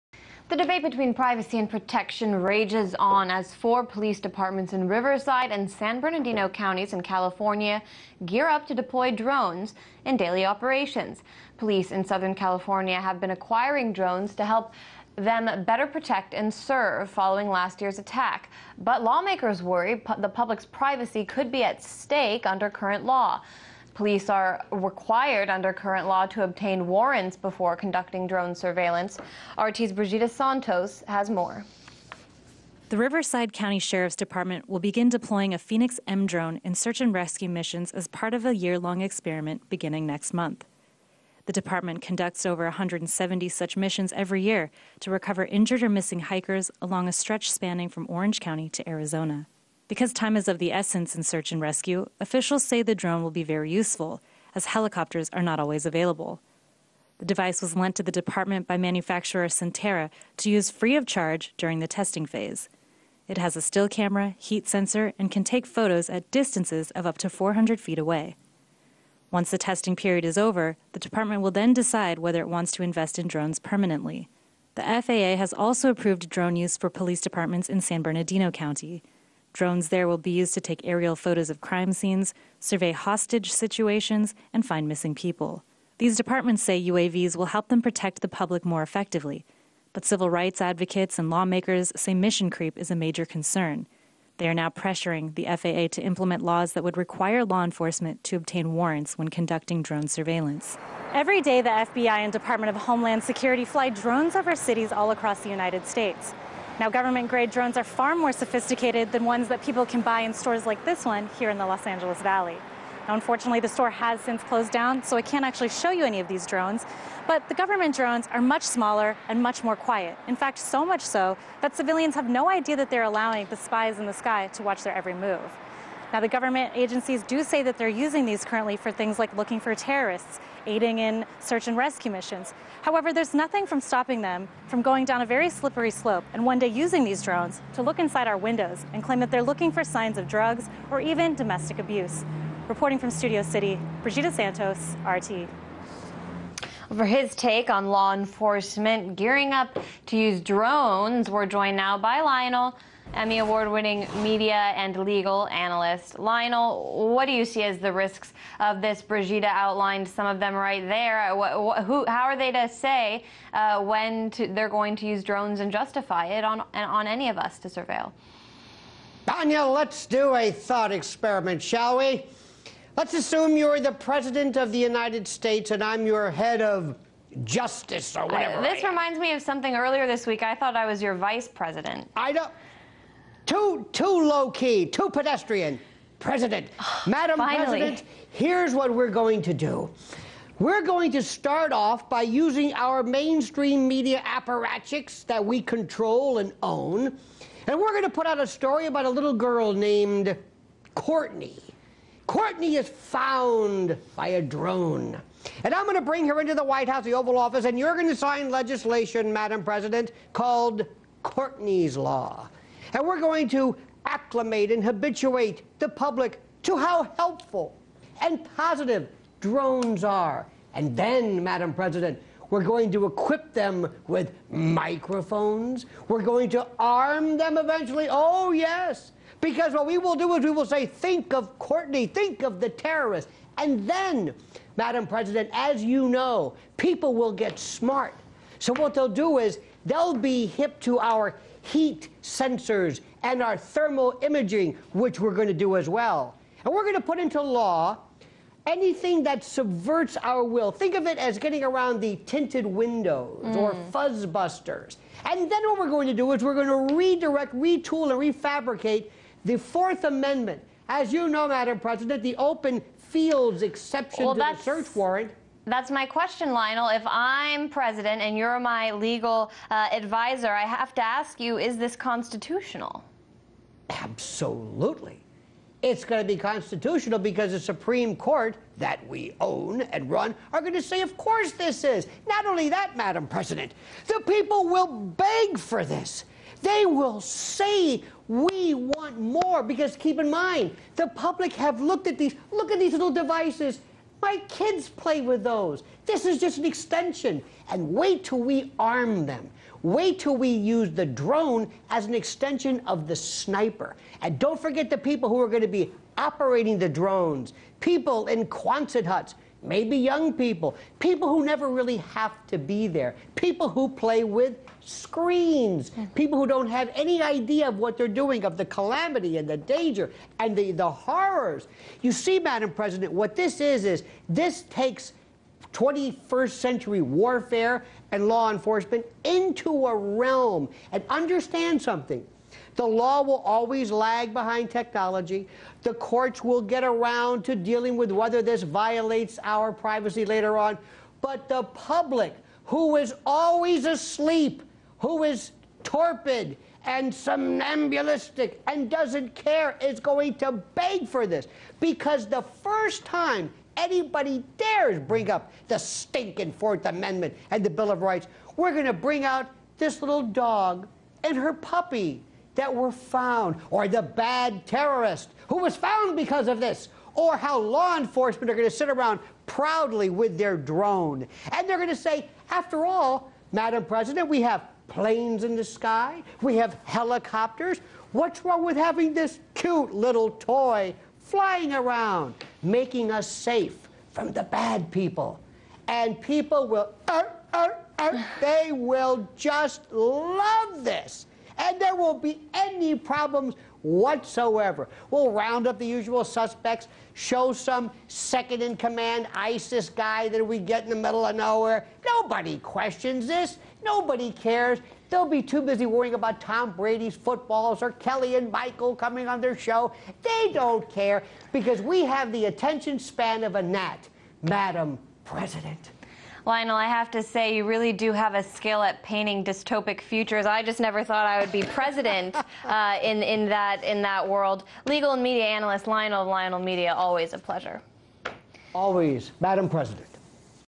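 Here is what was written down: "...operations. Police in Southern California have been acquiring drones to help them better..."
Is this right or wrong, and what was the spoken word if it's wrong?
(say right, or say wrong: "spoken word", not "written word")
right.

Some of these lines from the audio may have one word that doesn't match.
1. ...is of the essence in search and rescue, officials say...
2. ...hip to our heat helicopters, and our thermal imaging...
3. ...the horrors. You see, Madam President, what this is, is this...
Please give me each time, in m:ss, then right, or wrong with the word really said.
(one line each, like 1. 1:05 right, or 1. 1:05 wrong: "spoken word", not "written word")
1. 0:50 right
2. 4:00 wrong: "sensors", not "helicopters"
3. 5:20 right.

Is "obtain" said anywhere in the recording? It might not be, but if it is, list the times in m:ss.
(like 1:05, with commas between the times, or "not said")
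0:26, 1:38.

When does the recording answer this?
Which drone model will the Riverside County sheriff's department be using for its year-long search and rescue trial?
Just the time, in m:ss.
0:35.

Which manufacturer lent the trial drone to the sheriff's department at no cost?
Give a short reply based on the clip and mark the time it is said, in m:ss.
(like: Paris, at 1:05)
Sentera, at 0:59.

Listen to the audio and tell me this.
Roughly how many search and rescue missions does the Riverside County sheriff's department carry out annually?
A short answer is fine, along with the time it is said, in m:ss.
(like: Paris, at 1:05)
170, at 0:42.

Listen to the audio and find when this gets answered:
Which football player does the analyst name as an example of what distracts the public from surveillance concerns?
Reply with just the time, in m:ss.
6:46.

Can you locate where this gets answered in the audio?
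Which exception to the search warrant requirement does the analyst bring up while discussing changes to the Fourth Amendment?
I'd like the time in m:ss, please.
4:22.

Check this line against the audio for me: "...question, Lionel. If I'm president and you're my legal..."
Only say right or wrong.
right.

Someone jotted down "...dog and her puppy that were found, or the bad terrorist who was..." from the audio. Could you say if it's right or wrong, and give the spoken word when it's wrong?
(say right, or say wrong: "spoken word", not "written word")
right.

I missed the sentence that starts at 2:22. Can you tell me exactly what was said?
Reporting from Studio City, Brigida Santos, RT for his take on law enforcement gearing up to use drones.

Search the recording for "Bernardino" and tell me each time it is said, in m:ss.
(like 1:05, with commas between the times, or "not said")
0:06, 1:18.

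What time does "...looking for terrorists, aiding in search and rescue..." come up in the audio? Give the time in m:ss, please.
2:09.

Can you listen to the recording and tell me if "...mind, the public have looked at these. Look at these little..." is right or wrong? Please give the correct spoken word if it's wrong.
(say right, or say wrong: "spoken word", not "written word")
right.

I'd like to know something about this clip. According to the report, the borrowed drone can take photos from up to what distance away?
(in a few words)
400 feet.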